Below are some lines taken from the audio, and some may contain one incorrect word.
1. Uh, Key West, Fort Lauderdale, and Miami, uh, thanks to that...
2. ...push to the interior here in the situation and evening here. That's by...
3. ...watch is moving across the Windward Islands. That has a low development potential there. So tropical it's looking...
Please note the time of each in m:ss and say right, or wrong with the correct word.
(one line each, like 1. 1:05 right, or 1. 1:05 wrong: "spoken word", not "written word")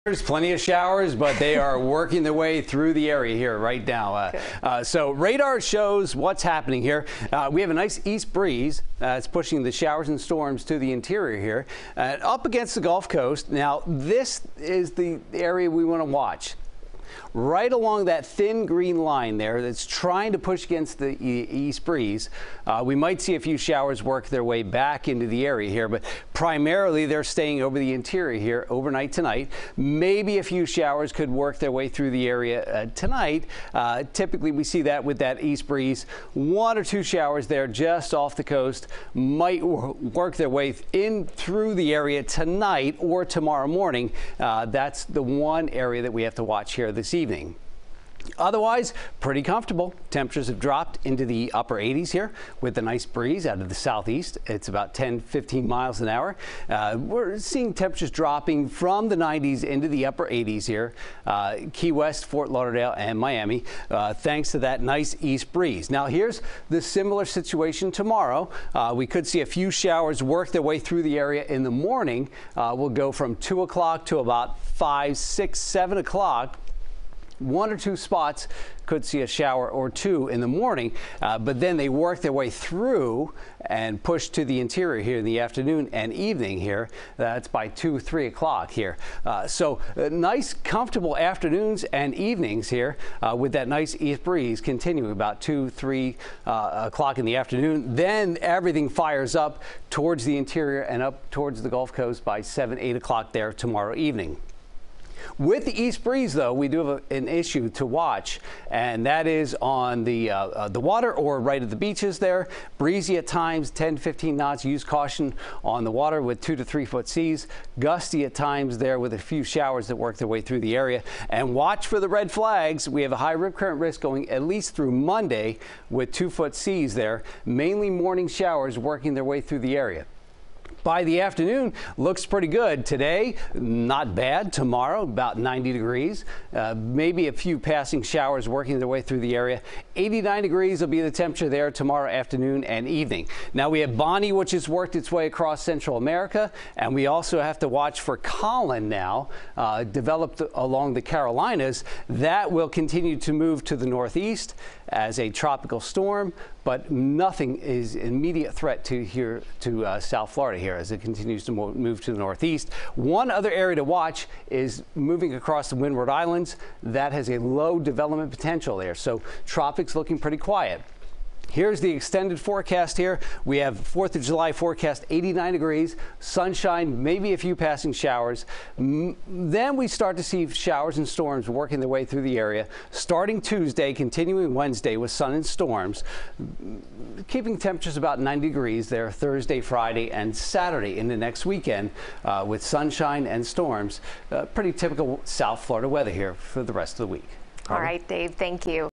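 1. 1:01 right
2. 1:24 wrong: "afternoon", not "situation"
3. 2:43 right.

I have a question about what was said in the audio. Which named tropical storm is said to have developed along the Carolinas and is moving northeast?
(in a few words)
Colin.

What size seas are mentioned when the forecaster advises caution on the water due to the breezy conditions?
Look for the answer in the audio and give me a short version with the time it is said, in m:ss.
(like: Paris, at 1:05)
2 to 3 feet, at 1:56.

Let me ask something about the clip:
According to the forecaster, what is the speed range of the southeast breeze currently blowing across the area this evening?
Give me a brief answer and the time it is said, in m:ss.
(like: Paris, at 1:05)
10-15 mph, at 0:54.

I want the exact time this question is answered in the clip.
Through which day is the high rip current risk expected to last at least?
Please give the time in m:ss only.
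2:04.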